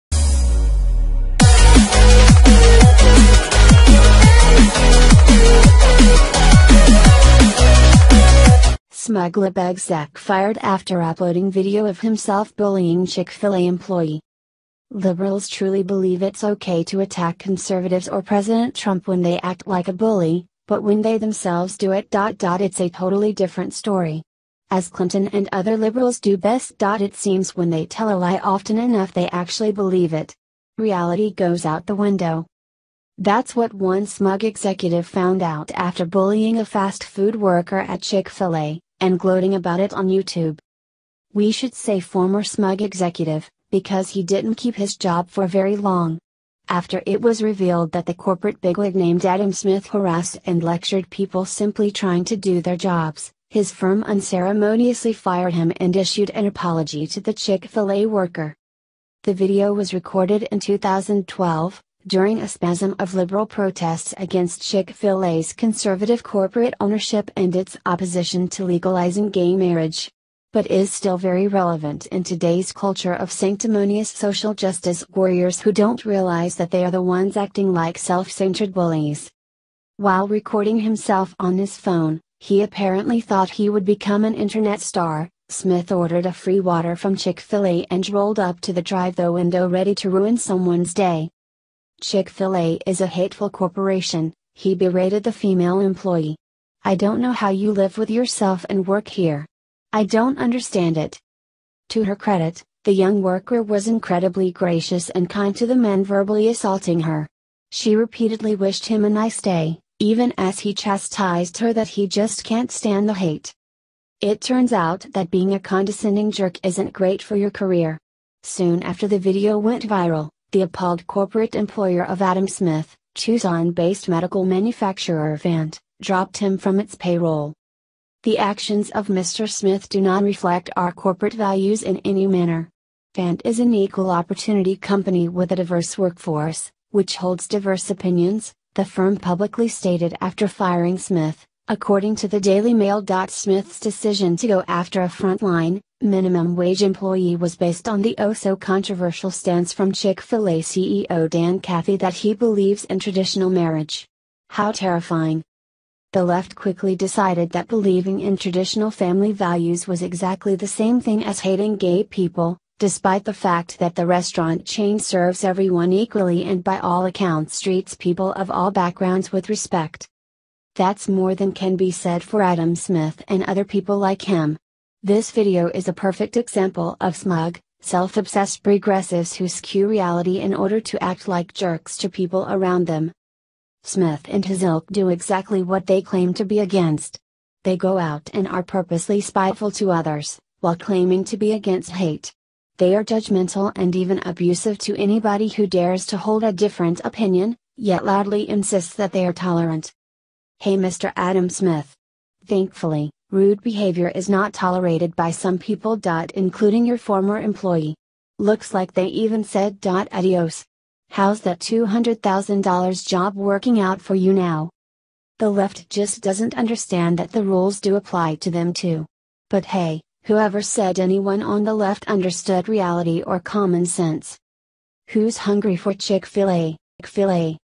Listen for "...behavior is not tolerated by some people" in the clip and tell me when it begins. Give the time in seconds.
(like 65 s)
203 s.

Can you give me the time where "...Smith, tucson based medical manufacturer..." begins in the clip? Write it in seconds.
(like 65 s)
122 s.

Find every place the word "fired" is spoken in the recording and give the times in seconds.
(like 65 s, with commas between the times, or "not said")
10 s, 55 s.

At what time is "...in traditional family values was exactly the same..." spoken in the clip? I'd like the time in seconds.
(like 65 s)
158 s.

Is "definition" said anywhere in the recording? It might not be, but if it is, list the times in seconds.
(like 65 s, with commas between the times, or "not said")
not said.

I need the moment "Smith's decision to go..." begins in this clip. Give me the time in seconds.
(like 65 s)
143 s.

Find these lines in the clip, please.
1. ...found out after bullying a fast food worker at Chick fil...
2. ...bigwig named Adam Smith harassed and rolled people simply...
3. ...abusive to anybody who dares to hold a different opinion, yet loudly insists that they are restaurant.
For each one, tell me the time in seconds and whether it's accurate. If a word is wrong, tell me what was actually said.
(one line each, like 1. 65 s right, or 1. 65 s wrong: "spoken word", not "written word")
1. 35 s right
2. 48 s wrong: "lectured", not "rolled"
3. 194 s wrong: "tolerant", not "restaurant".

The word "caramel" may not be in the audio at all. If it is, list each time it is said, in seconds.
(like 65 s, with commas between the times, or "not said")
not said.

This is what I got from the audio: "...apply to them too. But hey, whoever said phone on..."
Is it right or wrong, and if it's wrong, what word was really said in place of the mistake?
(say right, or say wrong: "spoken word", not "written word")
wrong: "anyone", not "phone".